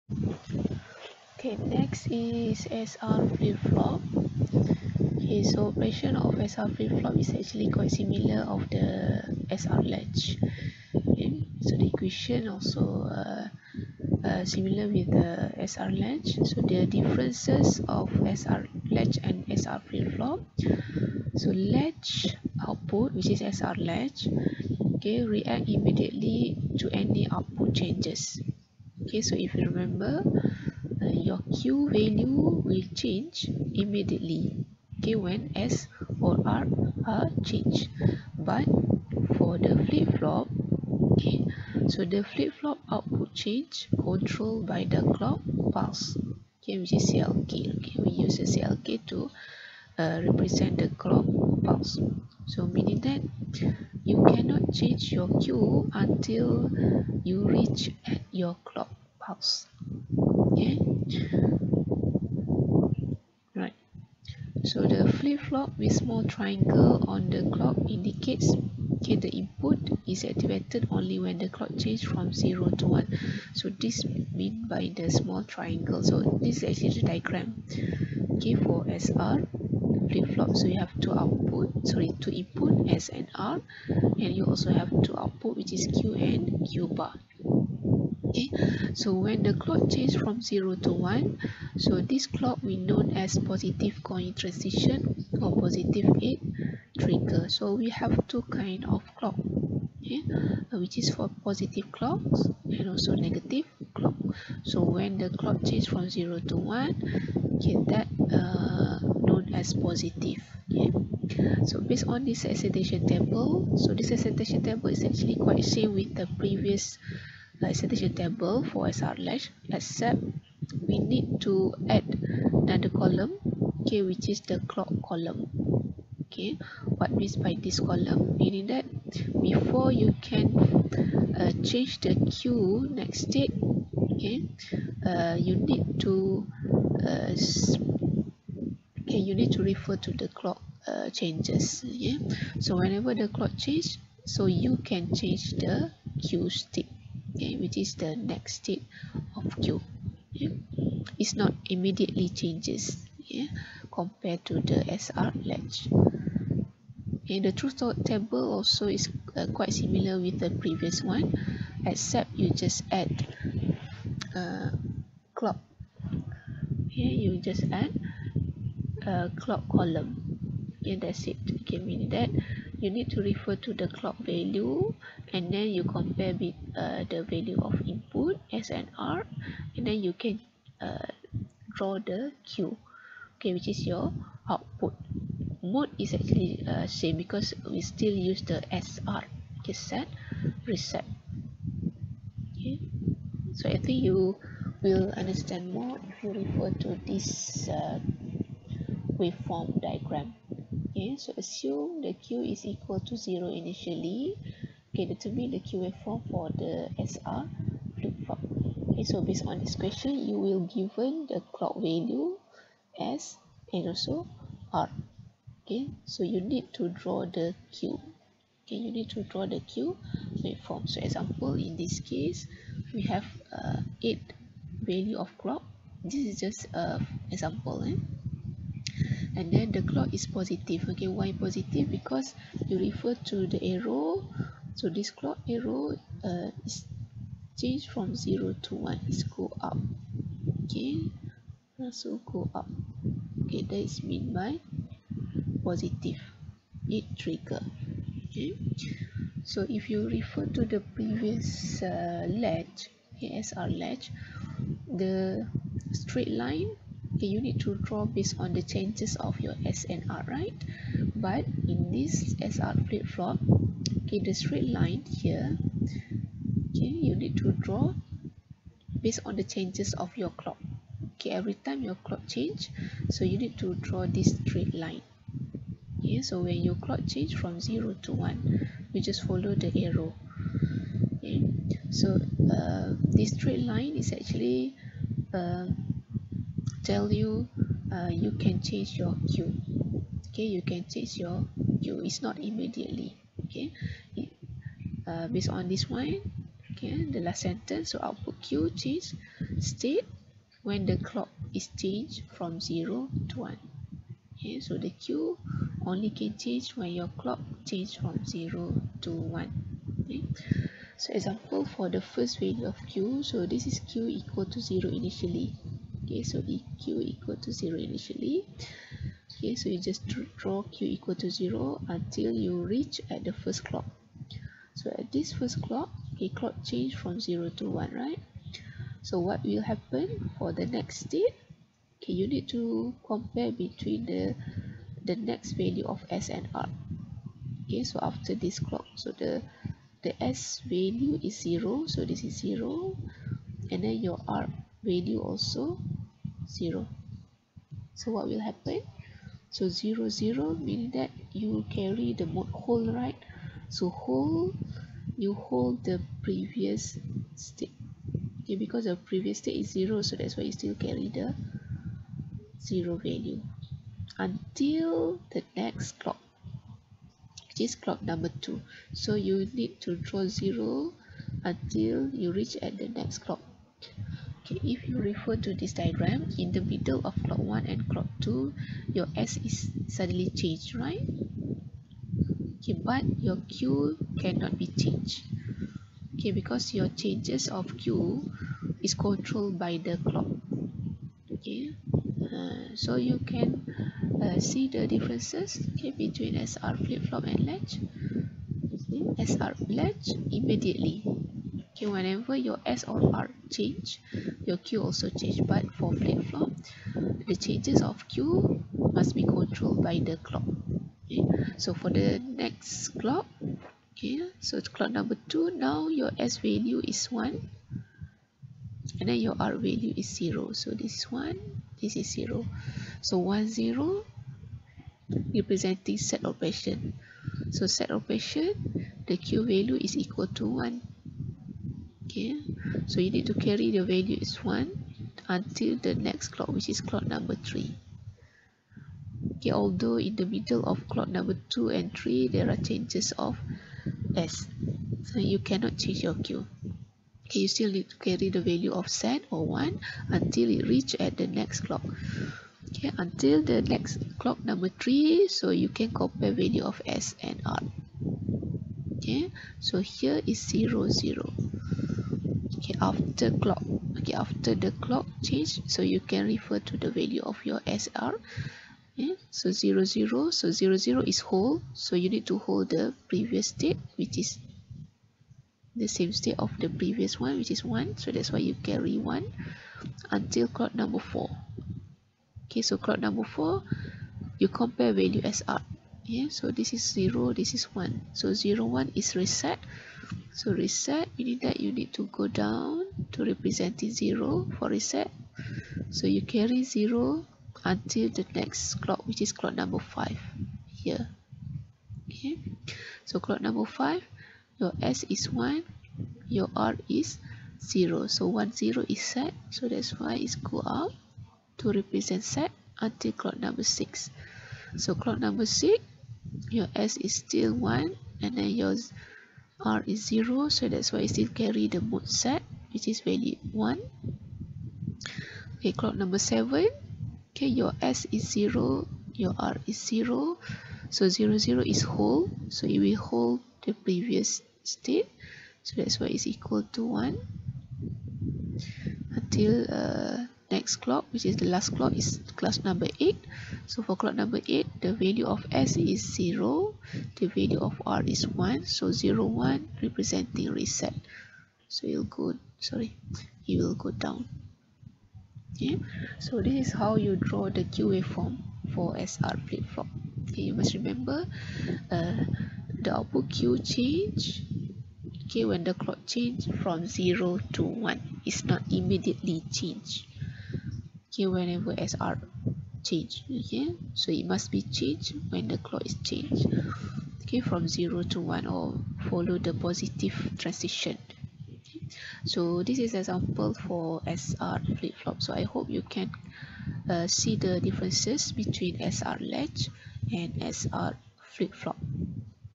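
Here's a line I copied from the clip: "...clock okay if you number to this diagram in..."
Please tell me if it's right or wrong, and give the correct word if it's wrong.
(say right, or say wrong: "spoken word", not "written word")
wrong: "refer", not "number".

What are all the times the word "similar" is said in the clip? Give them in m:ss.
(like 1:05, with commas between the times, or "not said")
0:07, 0:14, 2:39.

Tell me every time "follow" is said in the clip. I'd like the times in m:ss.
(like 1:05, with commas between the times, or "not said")
4:39, 9:39.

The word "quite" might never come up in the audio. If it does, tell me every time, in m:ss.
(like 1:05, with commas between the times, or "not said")
0:07, 1:55, 2:39.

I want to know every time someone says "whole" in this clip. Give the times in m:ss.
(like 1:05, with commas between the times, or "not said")
8:51.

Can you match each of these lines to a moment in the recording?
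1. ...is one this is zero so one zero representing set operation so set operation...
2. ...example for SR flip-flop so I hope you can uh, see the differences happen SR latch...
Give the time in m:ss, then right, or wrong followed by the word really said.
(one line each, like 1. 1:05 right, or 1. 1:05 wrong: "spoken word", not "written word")
1. 7:00 right
2. 9:42 wrong: "between", not "happen".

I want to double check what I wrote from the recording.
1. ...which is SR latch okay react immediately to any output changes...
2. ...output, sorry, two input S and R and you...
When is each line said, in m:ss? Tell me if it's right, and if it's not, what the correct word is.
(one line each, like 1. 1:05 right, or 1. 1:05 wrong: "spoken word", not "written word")
1. 0:23 right
2. 1:21 right.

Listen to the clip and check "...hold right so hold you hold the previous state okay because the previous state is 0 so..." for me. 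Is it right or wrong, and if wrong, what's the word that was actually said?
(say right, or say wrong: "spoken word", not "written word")
right.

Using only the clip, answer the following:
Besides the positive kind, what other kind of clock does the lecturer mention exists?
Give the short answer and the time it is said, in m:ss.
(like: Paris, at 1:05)
Negative clock, at 1:43.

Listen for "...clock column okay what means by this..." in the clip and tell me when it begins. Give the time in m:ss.
2:04.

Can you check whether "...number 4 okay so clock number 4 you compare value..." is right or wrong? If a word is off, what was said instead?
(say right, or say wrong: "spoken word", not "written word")
right.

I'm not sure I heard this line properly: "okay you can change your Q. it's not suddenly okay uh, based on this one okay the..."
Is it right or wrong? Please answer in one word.
wrong.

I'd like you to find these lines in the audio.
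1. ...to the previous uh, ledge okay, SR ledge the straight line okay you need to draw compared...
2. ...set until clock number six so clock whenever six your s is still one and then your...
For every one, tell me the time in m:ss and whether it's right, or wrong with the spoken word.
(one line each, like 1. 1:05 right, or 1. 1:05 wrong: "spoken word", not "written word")
1. 4:10 wrong: "based", not "compared"
2. 8:32 wrong: "number", not "whenever".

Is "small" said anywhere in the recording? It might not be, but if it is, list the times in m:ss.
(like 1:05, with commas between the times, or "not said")
1:05, 1:15.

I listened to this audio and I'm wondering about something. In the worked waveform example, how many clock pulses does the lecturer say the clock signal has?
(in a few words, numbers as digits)
8.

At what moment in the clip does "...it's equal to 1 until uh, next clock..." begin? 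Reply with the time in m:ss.
8:56.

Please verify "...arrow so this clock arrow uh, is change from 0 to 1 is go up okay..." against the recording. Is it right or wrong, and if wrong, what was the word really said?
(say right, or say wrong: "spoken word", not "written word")
right.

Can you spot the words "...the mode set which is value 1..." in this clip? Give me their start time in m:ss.
8:41.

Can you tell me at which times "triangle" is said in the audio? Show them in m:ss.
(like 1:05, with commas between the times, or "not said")
1:06, 1:15.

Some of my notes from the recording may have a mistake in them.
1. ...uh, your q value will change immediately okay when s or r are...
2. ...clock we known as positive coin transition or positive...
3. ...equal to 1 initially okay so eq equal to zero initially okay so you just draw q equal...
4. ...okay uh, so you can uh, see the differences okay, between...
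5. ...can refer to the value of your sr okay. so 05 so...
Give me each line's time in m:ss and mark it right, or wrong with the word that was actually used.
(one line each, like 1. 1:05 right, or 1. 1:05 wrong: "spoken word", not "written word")
1. 0:31 right
2. 1:32 right
3. 5:14 wrong: "0", not "1"
4. 6:31 right
5. 7:45 wrong: "00", not "05".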